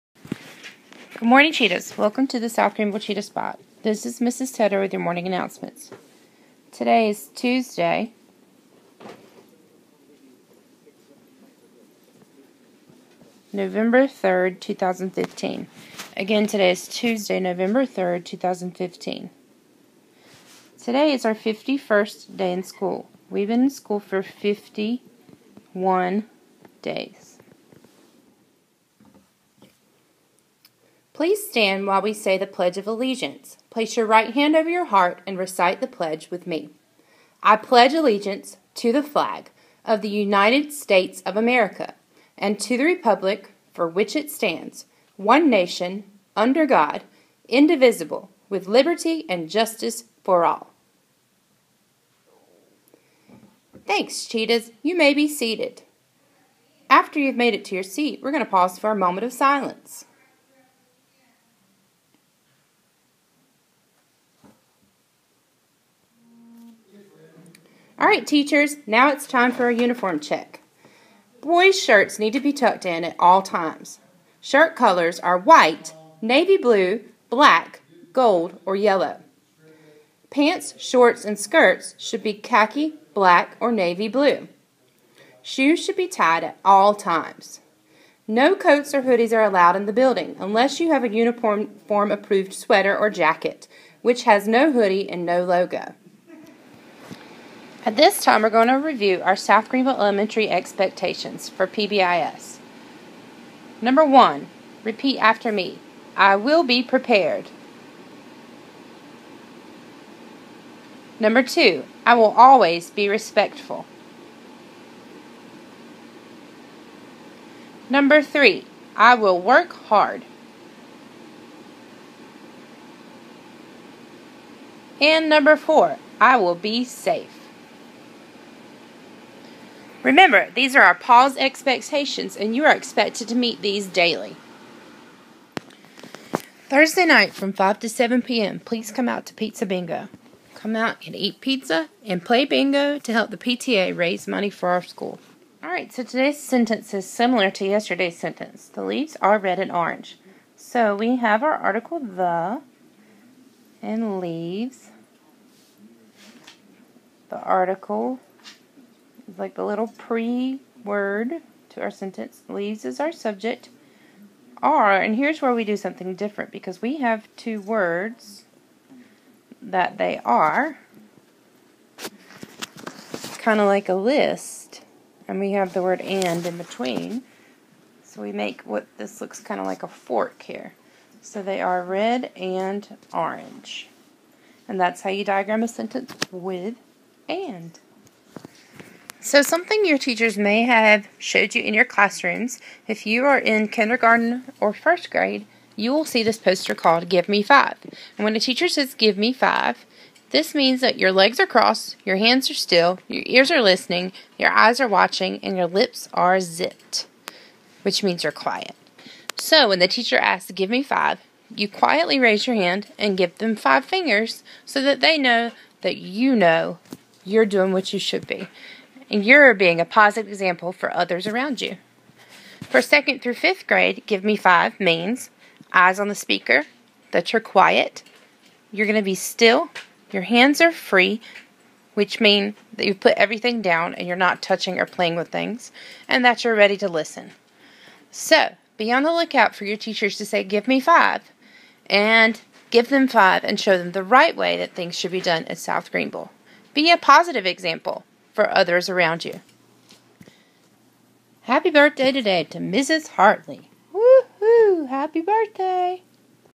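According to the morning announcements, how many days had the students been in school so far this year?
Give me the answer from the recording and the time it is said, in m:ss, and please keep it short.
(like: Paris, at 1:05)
51, at 0:21.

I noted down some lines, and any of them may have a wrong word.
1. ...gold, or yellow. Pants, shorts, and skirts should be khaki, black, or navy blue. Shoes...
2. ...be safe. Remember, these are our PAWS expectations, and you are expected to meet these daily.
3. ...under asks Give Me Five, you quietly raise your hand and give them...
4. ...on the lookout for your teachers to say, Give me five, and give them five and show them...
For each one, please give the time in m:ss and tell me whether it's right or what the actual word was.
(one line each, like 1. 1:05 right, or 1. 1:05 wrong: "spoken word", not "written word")
1. 1:18 right
2. 2:06 right
3. 3:29 wrong: "teacher", not "under"
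4. 3:58 right.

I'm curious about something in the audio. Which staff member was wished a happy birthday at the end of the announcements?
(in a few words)
Mrs. Hartley.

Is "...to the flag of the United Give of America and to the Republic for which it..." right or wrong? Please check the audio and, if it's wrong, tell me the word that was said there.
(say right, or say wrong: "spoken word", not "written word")
wrong: "States", not "Give".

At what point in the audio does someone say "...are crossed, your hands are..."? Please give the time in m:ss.
3:21.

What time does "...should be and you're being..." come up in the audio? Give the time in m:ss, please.
3:37.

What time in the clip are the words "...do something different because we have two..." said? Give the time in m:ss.
2:45.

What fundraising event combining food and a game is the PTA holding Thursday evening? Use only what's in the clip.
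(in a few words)
Pizza Bingo.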